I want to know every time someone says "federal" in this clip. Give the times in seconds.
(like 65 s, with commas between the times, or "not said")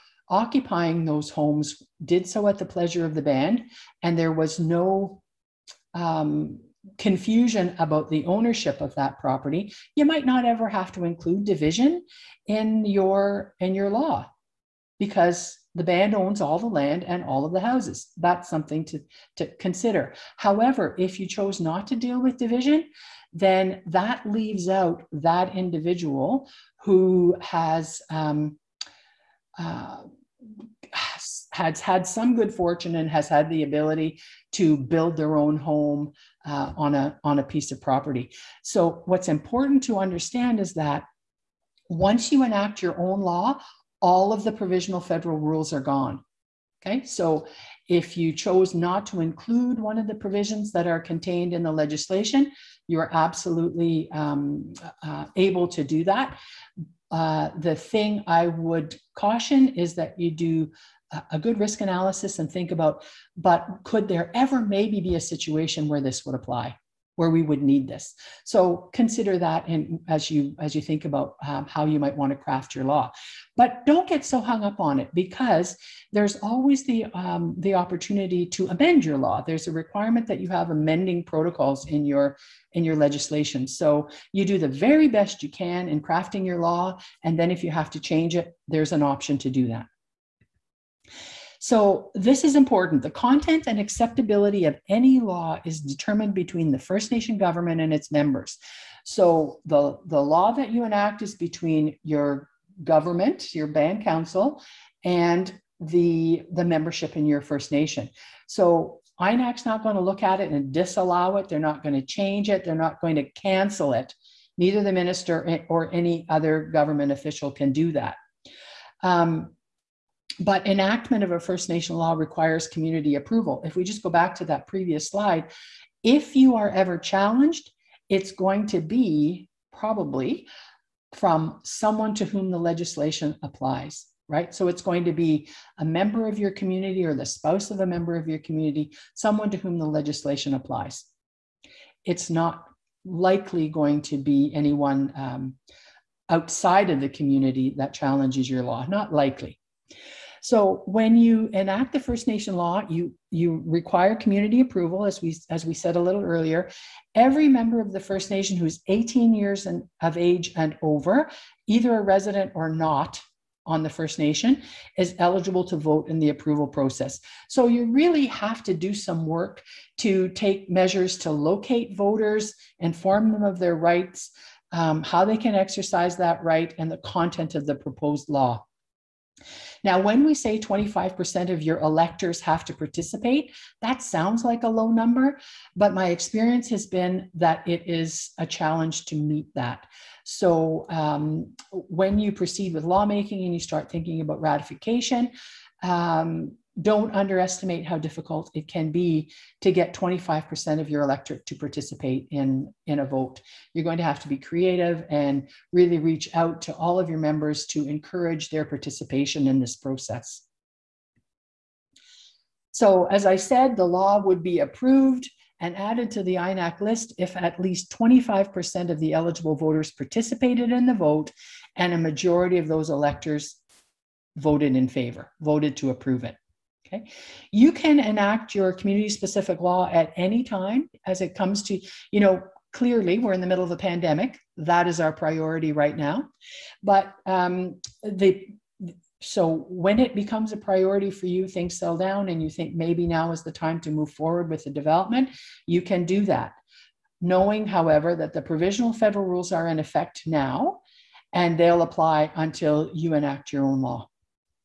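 45 s, 248 s.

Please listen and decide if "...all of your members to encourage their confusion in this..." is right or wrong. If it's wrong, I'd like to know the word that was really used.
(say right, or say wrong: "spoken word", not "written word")
wrong: "participation", not "confusion".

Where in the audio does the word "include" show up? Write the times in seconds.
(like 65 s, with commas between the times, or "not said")
11 s, 49 s.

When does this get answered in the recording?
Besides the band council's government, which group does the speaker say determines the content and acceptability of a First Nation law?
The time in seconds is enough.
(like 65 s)
97 s.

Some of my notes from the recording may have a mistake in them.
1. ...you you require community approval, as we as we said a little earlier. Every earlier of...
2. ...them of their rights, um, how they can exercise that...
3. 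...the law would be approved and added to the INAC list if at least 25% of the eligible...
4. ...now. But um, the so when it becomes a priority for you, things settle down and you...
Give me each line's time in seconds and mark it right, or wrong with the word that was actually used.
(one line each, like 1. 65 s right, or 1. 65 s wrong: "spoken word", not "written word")
1. 152 s wrong: "member", not "earlier"
2. 173 s right
3. 213 s right
4. 235 s right.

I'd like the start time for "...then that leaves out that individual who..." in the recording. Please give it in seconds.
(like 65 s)
23 s.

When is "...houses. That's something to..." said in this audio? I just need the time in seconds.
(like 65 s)
17 s.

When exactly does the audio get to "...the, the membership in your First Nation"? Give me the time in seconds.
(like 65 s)
105 s.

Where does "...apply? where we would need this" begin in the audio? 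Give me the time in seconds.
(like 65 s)
66 s.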